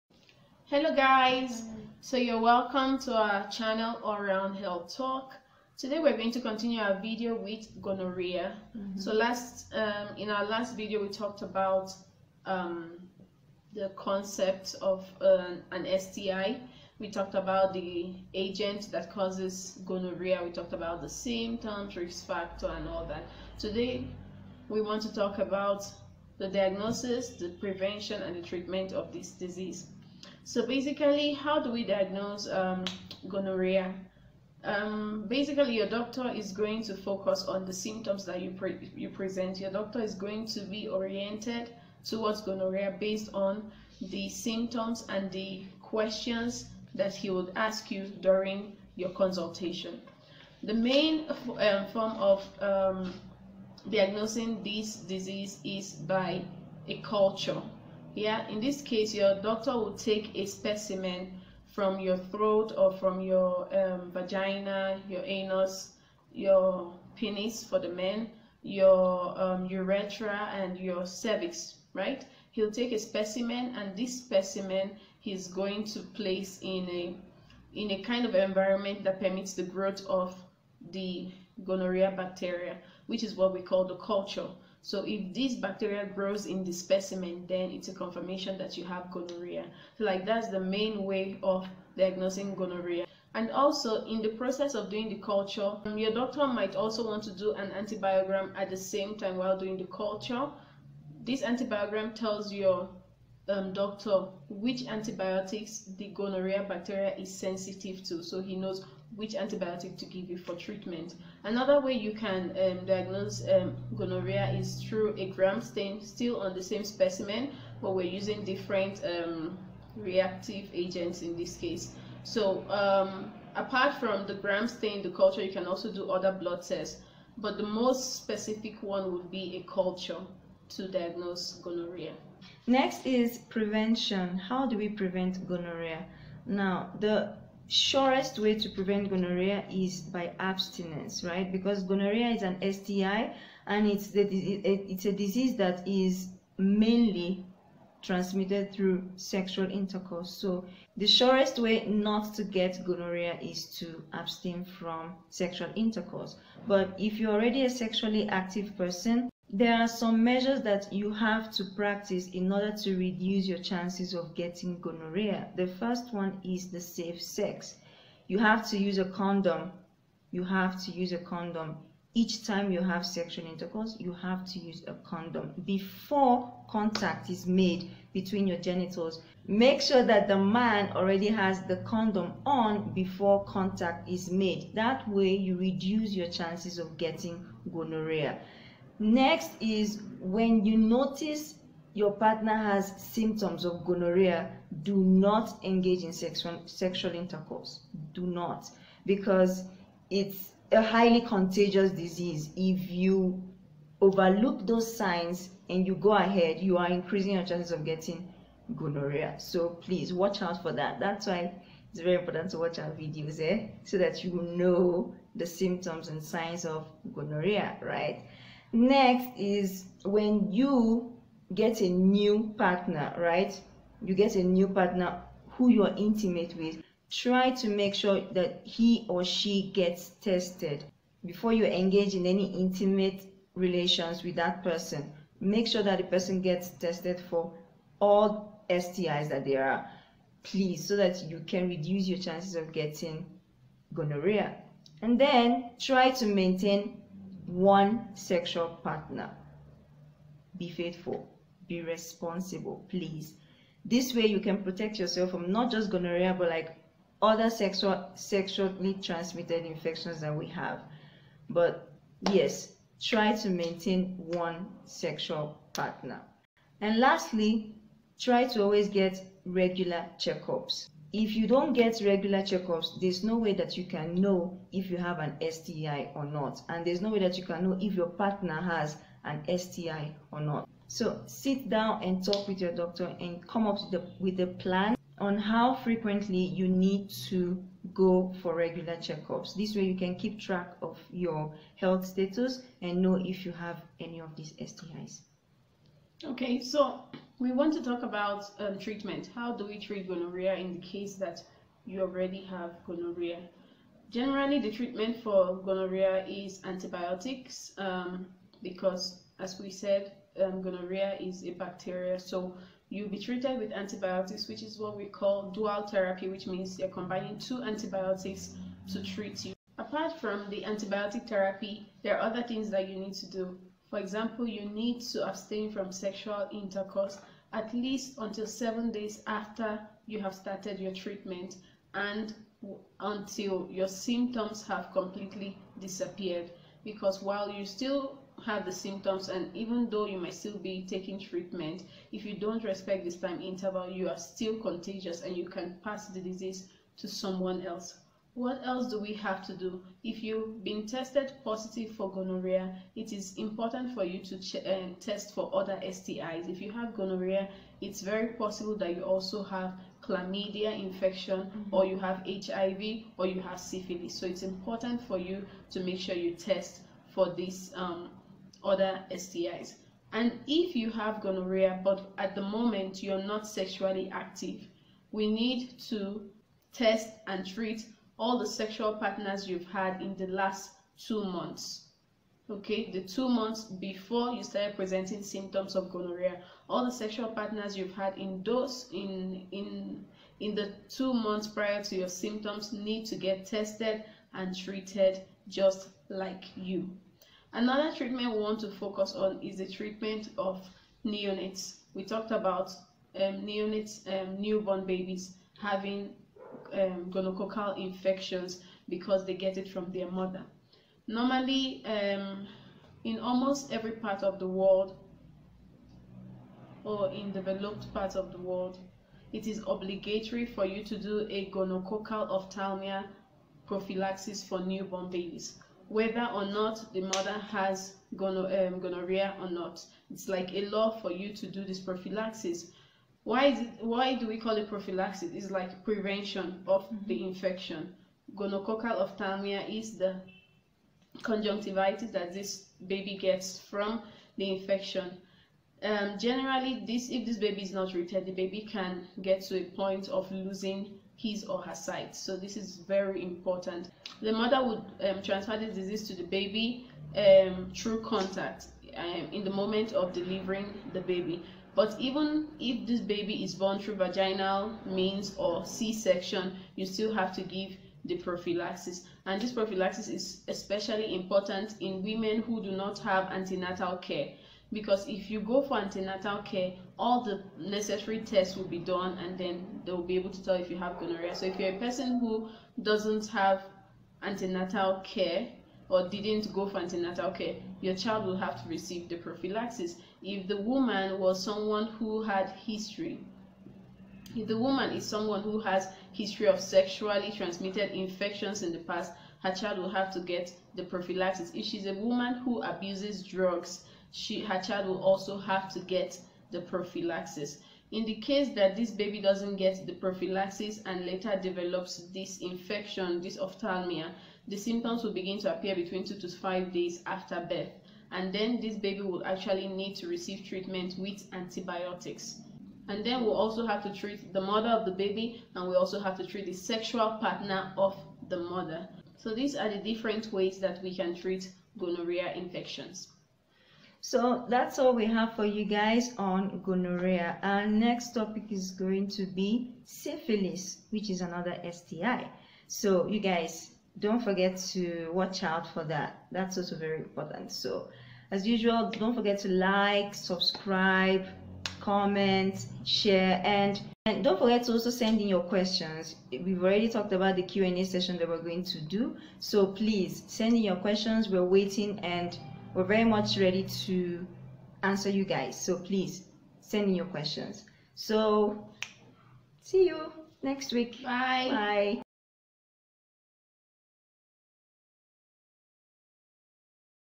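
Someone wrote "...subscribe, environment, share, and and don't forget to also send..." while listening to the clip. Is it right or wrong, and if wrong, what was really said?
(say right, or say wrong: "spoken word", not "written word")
wrong: "comment", not "environment".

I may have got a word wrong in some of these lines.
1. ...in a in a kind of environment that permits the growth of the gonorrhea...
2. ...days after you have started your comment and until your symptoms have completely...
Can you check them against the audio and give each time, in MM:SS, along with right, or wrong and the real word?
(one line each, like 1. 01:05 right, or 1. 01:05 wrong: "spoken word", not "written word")
1. 01:16 right
2. 05:28 wrong: "treatment", not "comment".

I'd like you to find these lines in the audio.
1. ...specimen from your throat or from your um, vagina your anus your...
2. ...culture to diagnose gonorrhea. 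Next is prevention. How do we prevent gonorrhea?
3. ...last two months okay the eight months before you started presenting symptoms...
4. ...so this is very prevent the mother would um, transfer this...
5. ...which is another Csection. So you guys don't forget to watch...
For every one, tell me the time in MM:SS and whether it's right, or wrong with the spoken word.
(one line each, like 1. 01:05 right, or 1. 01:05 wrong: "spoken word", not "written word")
1. 01:00 right
2. 02:09 right
3. 06:20 wrong: "two", not "eight"
4. 07:32 wrong: "important", not "prevent"
5. 09:00 wrong: "STI", not "Csection".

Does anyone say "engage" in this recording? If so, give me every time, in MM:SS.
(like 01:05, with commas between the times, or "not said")
03:15, 03:51.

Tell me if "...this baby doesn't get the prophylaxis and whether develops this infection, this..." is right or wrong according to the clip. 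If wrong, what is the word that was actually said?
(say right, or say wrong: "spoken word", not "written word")
wrong: "later", not "whether".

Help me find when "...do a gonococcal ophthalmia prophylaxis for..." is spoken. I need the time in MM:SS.
07:00.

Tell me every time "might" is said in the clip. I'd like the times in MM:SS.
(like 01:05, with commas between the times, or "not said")
01:36, 05:40.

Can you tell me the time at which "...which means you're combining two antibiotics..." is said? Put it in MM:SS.
05:16.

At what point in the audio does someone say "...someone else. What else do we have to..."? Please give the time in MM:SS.
05:47.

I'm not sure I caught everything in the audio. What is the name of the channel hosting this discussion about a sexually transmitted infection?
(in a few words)
All Round Health Talk.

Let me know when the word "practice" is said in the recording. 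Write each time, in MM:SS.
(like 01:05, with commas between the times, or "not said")
02:41.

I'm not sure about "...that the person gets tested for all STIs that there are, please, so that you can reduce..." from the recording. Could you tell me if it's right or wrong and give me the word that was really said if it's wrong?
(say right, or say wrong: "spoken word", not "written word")
right.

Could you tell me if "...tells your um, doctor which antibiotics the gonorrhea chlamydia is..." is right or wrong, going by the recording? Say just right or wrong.
wrong.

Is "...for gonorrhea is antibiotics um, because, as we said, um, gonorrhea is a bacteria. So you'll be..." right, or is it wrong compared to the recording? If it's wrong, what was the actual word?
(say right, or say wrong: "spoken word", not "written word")
right.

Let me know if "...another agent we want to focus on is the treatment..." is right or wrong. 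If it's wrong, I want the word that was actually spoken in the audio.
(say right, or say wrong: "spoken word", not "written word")
wrong: "treatment", not "agent".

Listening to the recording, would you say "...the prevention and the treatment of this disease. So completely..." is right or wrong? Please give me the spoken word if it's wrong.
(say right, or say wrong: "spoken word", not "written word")
wrong: "basically", not "completely".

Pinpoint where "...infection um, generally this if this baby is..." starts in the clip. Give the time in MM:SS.
07:24.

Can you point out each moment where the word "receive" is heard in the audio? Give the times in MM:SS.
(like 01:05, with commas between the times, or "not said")
08:08, 08:40.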